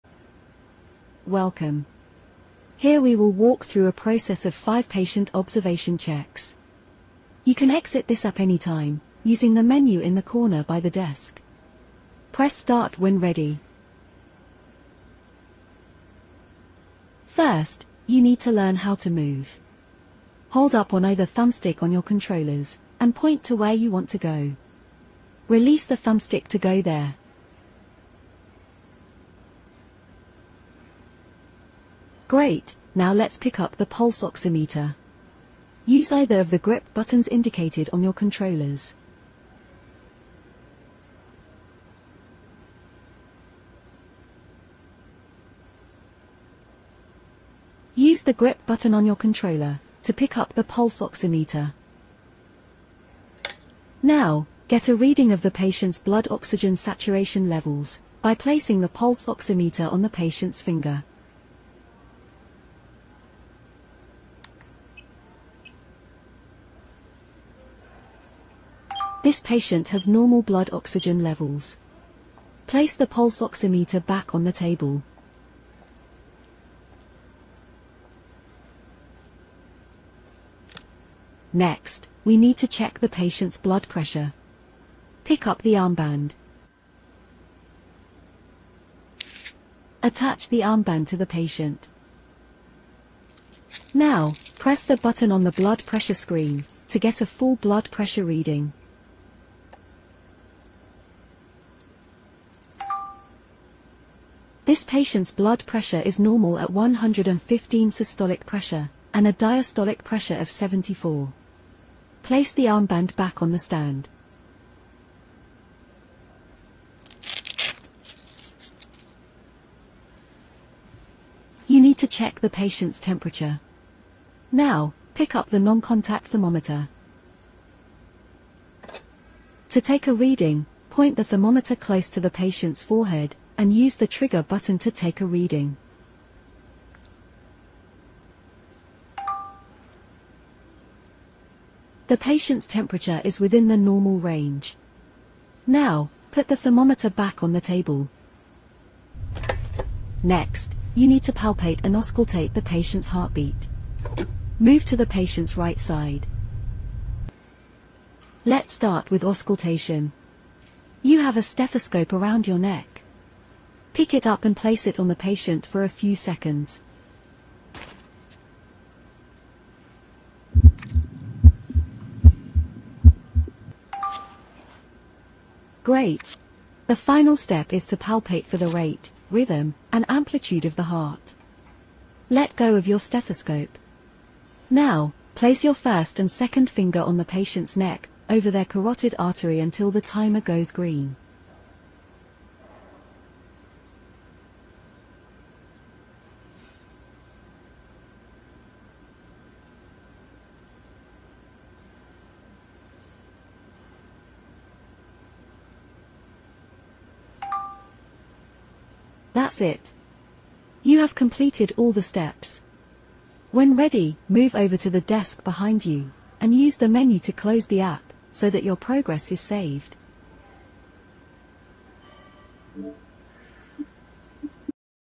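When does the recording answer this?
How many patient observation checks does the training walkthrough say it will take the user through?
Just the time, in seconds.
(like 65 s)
4 s.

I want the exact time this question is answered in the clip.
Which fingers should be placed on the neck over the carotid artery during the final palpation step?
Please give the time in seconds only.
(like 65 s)
185 s.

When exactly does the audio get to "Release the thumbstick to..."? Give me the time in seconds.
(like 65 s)
25 s.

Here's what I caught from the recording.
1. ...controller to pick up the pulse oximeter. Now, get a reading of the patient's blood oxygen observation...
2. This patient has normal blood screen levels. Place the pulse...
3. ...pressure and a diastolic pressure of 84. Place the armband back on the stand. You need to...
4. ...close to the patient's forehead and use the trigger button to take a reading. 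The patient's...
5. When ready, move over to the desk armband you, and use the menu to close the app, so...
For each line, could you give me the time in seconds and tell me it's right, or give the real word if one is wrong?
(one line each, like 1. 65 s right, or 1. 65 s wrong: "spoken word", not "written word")
1. 49 s wrong: "saturation", not "observation"
2. 69 s wrong: "oxygen", not "screen"
3. 108 s wrong: "74", not "84"
4. 131 s right
5. 213 s wrong: "behind", not "armband".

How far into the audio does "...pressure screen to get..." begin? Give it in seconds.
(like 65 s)
95 s.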